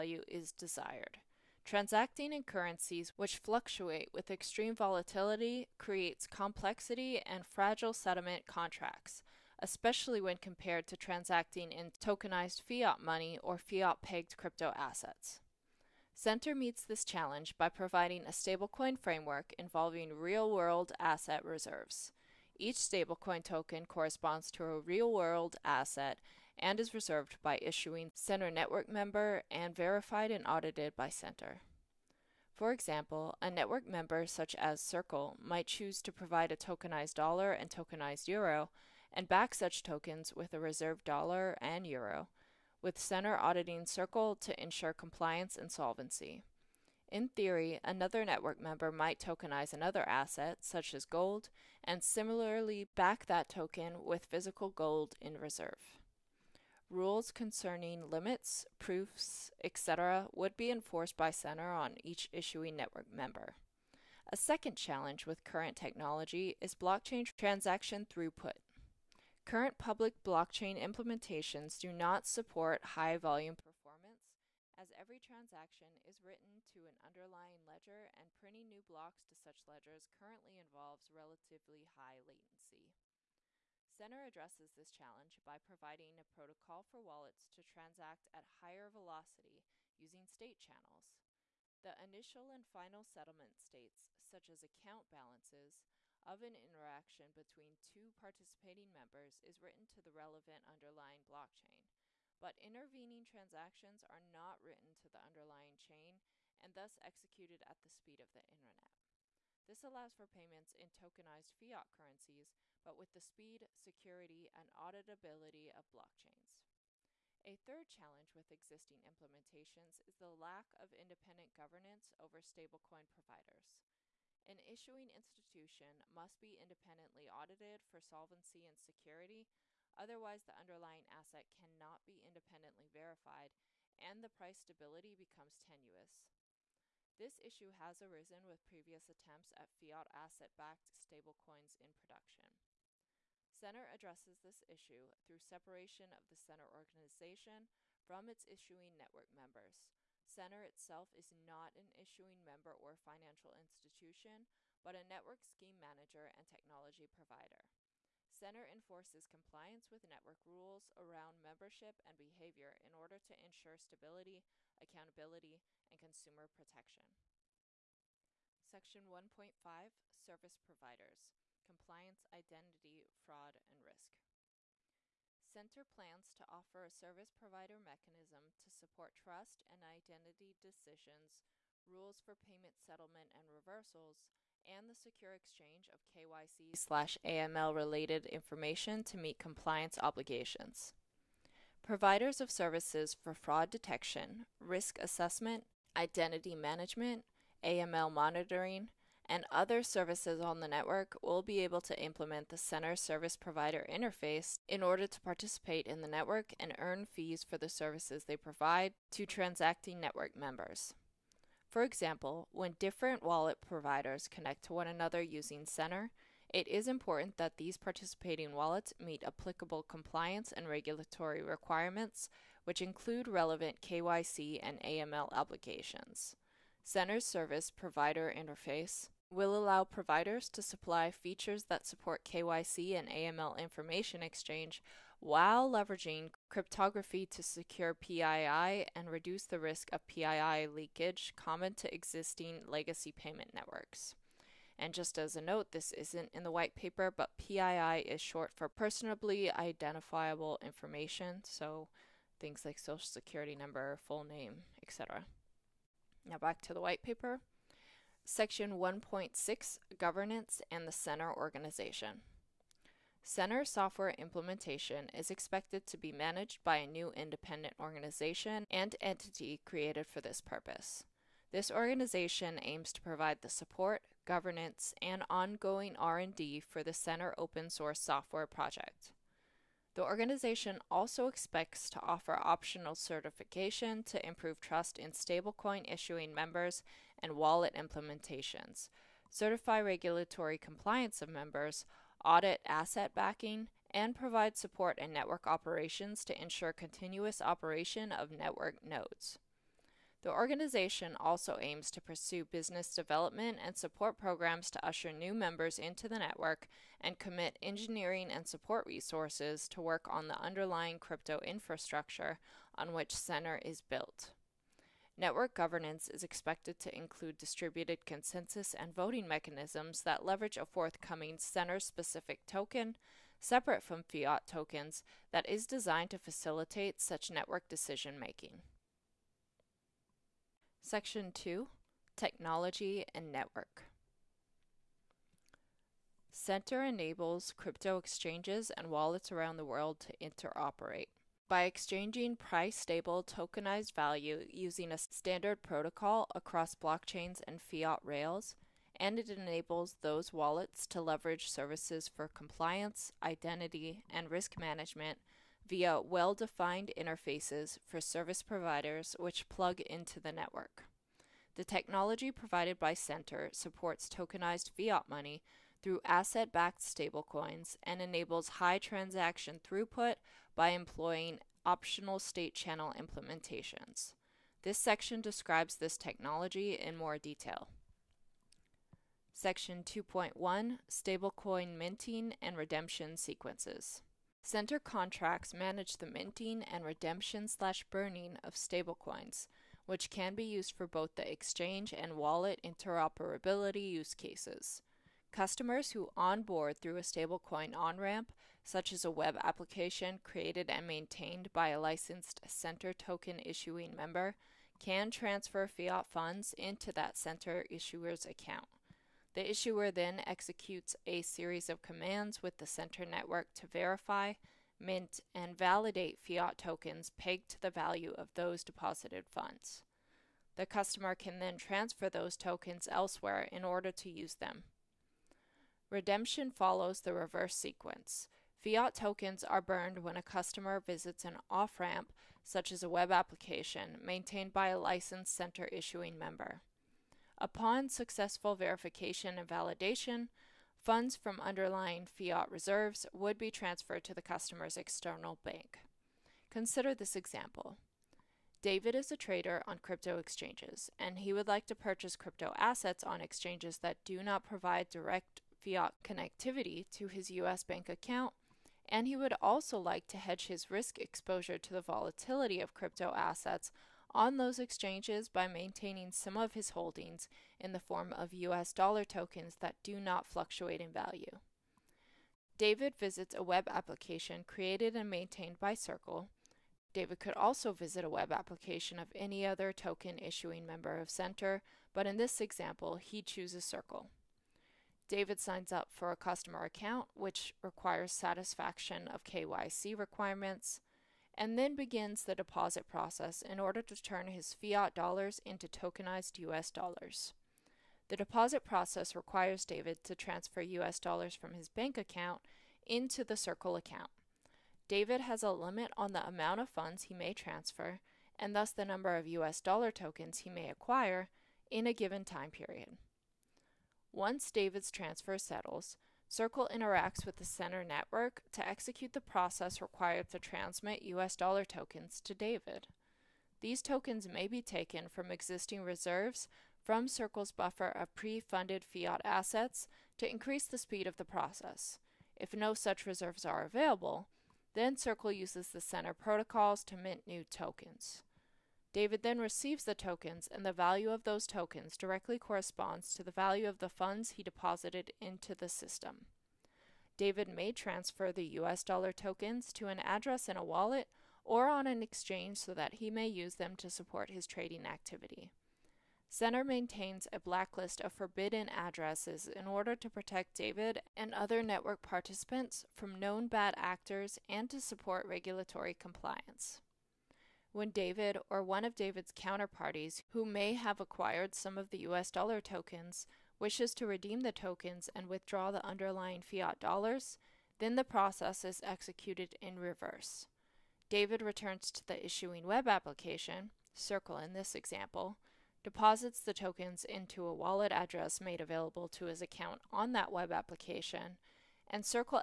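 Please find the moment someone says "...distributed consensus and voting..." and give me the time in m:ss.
5:17.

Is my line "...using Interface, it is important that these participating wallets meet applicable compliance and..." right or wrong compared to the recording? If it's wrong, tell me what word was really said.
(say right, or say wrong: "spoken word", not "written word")
wrong: "Center", not "Interface".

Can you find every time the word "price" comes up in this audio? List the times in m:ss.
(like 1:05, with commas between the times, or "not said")
2:14, 5:42.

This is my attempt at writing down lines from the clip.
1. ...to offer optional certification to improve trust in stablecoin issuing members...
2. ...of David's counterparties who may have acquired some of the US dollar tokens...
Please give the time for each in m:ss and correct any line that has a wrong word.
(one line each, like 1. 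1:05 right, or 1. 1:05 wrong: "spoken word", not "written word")
1. 4:41 right
2. 9:28 right.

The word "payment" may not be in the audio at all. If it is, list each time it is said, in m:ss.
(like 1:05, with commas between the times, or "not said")
1:50, 3:02, 4:03.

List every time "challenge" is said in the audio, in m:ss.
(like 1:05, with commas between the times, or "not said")
0:17, 1:04, 1:24, 1:57.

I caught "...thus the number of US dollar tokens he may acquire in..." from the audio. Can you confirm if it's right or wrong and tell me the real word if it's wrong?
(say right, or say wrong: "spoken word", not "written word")
right.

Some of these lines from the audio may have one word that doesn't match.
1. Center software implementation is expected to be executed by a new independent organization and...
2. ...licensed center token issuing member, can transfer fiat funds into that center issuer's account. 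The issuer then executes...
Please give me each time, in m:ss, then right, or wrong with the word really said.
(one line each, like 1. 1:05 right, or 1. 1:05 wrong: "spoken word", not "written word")
1. 4:23 wrong: "managed", not "executed"
2. 6:41 right.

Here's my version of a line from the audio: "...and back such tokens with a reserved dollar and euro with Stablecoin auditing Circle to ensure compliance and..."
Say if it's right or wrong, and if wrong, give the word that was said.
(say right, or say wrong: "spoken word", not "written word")
wrong: "Center", not "Stablecoin".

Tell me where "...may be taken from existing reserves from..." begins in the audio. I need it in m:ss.
8:44.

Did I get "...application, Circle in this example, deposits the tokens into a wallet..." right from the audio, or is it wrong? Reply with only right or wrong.
right.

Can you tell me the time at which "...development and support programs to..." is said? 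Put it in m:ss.
5:02.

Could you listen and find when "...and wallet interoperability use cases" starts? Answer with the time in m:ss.
6:31.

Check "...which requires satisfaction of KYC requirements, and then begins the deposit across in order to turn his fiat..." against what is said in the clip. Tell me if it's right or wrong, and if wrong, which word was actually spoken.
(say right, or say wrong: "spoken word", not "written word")
wrong: "process", not "across".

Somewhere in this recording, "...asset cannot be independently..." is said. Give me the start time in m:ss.
2:11.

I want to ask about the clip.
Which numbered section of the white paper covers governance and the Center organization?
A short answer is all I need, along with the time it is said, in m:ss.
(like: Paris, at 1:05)
1.6, at 4:18.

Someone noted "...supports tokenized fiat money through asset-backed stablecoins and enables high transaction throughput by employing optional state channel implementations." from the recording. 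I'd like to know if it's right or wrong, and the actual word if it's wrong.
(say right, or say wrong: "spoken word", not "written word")
right.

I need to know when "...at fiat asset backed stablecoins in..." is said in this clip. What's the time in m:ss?
2:19.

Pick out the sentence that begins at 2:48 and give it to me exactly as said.
Section 1.5 Service Providers Compliance, Identity, Fraud, and Risk.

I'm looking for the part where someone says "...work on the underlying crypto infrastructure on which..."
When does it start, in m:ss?
5:09.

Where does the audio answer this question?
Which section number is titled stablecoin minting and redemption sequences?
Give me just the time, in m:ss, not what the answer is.
6:19.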